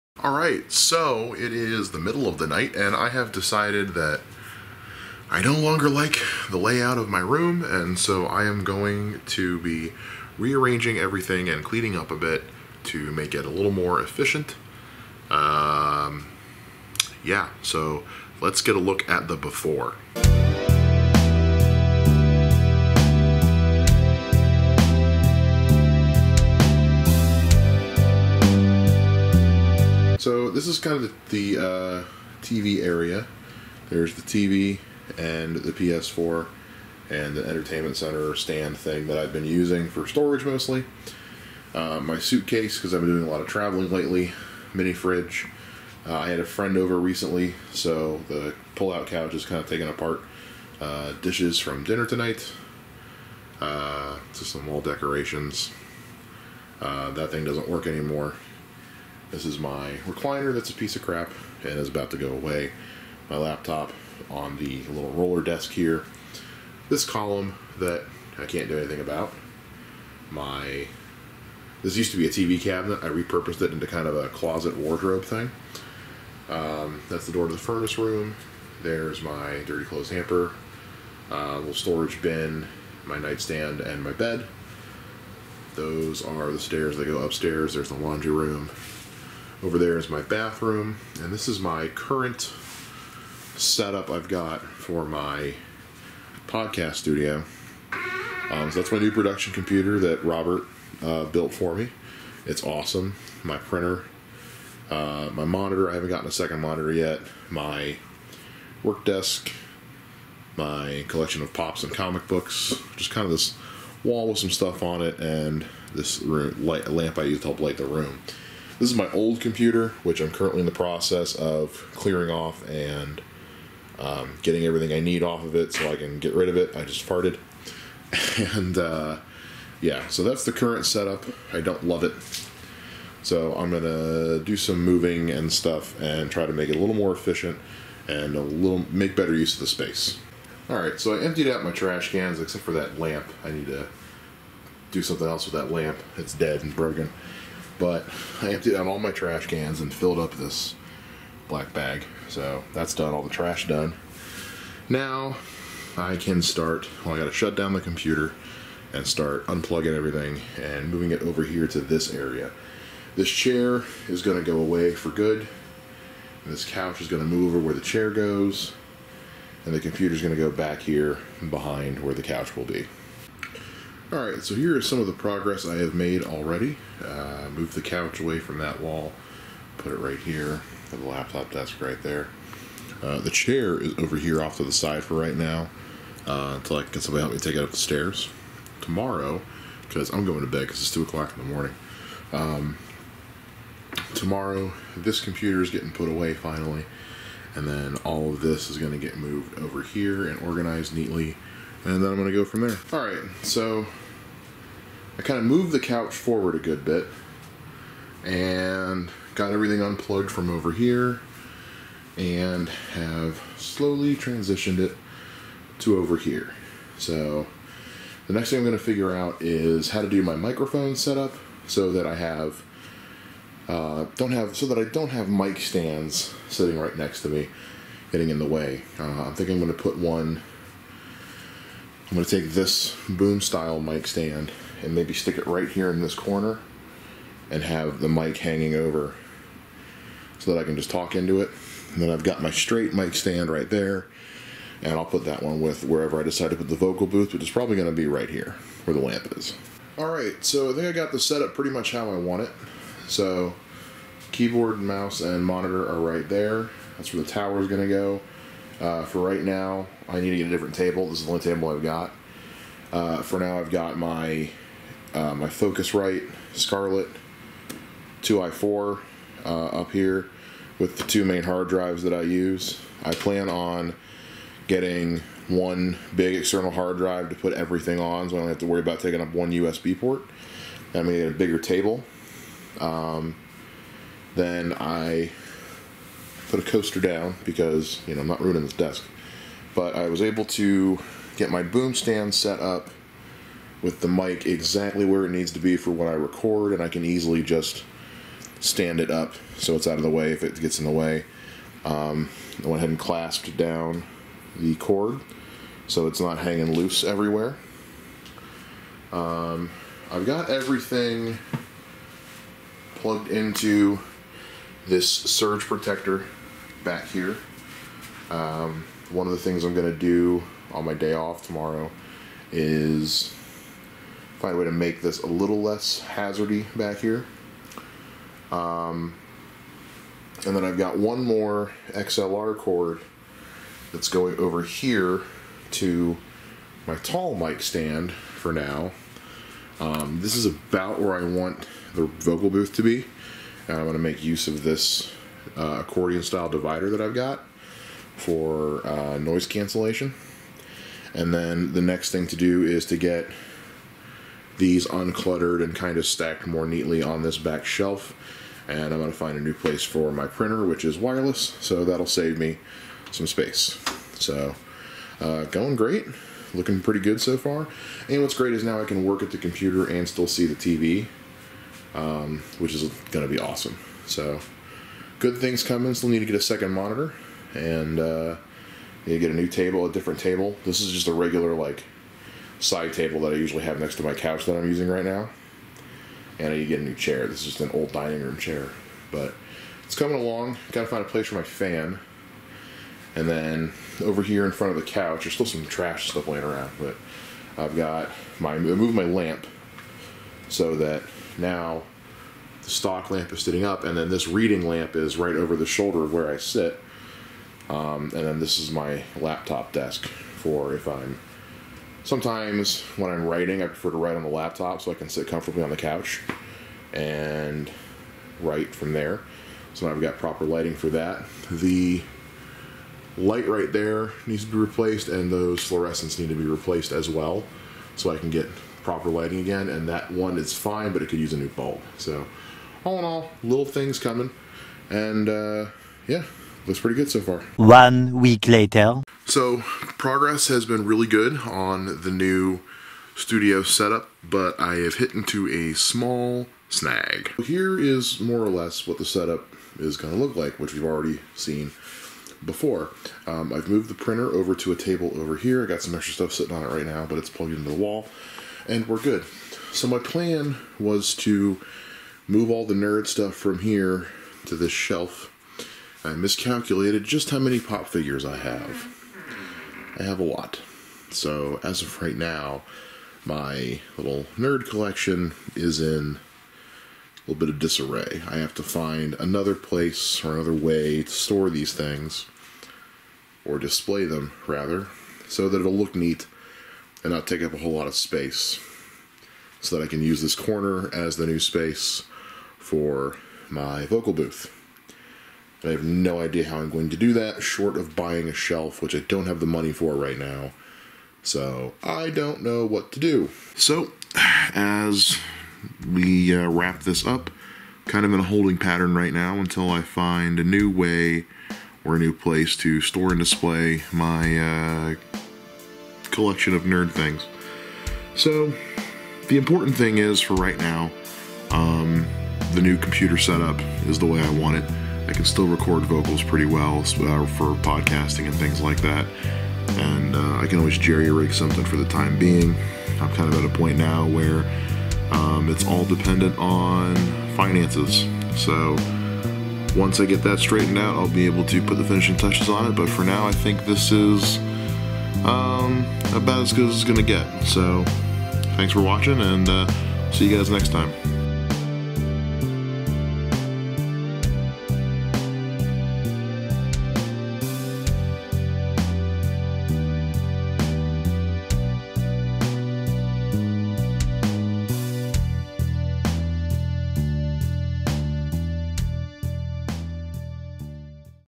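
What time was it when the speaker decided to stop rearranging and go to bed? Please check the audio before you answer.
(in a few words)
2 o'clock.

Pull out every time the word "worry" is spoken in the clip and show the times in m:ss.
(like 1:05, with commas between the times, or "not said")
4:38.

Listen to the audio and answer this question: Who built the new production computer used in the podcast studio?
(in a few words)
Robert.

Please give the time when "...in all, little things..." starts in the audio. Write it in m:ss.
7:12.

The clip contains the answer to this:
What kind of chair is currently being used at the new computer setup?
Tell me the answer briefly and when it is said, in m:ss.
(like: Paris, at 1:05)
Old dining room chair, at 6:27.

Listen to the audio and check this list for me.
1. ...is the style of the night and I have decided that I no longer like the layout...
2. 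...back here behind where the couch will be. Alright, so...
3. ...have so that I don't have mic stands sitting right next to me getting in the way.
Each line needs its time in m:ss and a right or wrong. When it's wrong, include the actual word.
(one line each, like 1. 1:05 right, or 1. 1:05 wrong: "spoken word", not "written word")
1. 0:01 wrong: "middle", not "style"
2. 2:50 right
3. 3:44 right.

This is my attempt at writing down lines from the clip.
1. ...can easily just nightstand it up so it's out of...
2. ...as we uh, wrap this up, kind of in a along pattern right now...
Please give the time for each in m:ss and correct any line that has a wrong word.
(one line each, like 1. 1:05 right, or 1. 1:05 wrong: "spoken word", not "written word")
1. 4:56 wrong: "stand", not "nightstand"
2. 8:24 wrong: "holding", not "along".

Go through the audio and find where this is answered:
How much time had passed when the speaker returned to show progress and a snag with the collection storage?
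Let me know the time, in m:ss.
7:17.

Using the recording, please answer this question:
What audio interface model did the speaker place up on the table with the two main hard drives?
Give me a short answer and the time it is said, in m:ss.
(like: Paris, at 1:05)
Focusrite Scarlett 2i4, at 4:25.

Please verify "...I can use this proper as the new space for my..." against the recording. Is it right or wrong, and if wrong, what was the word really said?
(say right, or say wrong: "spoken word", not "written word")
wrong: "corner", not "proper".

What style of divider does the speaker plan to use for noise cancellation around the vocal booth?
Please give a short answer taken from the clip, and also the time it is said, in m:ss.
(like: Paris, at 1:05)
Accordion style, at 5:45.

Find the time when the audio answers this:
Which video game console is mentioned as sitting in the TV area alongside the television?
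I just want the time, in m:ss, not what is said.
0:35.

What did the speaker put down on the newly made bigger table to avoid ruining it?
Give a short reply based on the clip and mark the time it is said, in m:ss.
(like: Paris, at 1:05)
A coaster, at 4:46.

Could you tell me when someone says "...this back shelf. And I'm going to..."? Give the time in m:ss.
5:57.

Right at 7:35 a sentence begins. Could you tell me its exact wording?
I got some extra stuff sitting on it right now, but it's plugged into the wall, and we're good.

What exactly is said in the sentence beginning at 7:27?
Here is more or less what the setup is going to look like, which we've already seen before.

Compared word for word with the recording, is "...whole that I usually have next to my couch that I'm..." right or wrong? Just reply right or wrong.
wrong.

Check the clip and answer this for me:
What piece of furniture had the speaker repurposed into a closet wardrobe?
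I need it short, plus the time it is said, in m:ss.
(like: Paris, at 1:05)
TV cabinet, at 1:12.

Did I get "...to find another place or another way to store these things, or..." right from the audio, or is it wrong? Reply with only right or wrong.
right.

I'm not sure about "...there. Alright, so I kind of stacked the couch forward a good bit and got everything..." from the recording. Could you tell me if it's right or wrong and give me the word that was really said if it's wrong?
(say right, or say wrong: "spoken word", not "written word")
wrong: "moved", not "stacked".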